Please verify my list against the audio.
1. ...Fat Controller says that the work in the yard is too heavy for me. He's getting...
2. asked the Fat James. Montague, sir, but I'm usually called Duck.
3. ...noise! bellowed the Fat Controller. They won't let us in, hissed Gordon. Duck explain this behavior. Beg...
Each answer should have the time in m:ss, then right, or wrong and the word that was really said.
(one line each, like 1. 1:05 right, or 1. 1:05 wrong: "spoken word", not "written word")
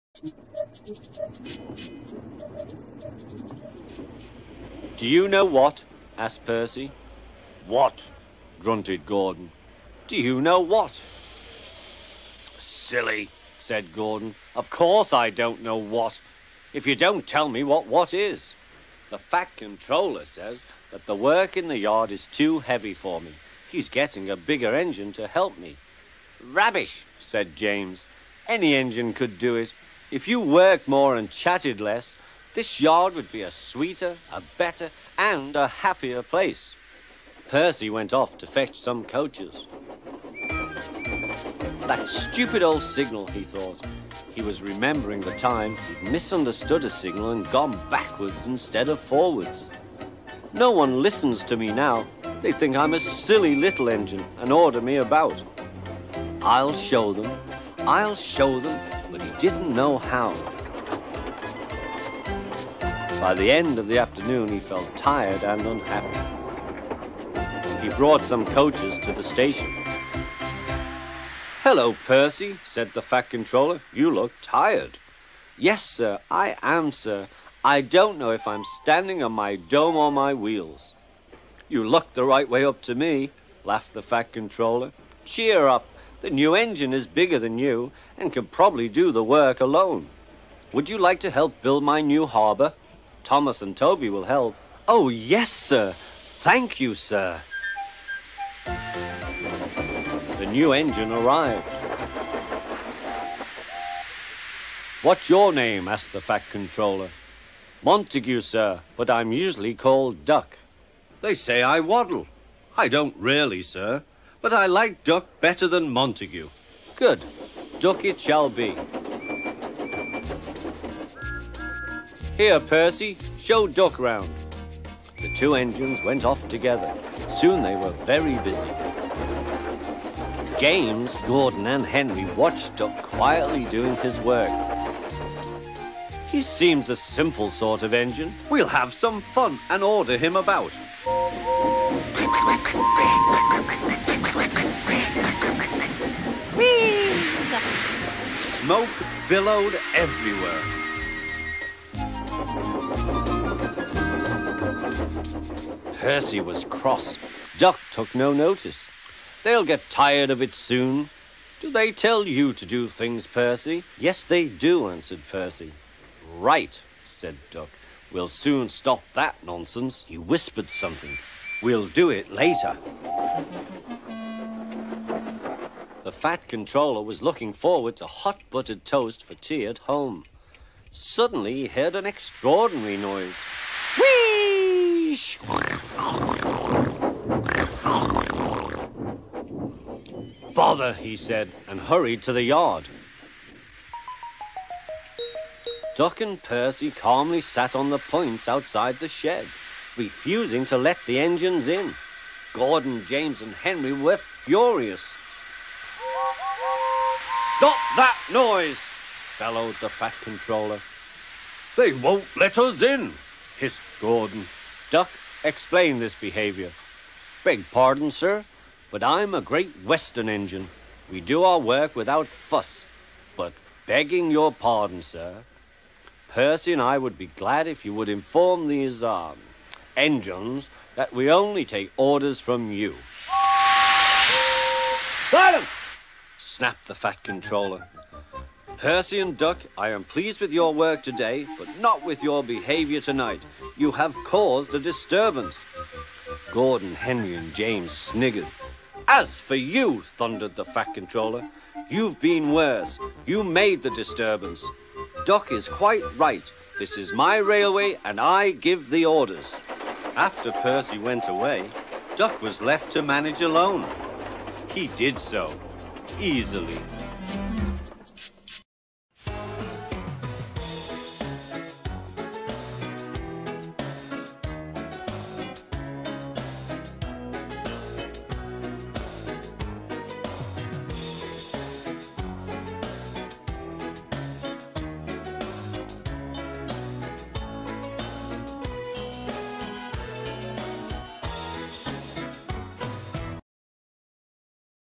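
1. 0:19 right
2. 1:45 wrong: "Controller", not "James"
3. 3:28 right.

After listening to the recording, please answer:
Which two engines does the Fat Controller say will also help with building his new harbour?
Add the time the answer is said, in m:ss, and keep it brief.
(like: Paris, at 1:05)
Thomas and Toby, at 1:33.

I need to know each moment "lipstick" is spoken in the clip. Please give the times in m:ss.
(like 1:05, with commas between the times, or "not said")
not said.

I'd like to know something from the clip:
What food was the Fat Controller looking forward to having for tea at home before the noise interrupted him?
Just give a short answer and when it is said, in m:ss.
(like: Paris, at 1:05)
Hot buttered toast, at 2:58.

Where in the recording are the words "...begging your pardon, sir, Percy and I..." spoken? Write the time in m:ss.
3:43.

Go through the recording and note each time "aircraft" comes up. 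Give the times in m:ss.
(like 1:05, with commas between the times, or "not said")
not said.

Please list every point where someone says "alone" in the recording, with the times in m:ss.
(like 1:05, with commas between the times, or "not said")
1:29, 4:23.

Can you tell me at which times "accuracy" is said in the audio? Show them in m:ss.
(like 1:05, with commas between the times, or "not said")
not said.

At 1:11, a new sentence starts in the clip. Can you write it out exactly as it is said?
Hello, Percy, said the Fat Controller.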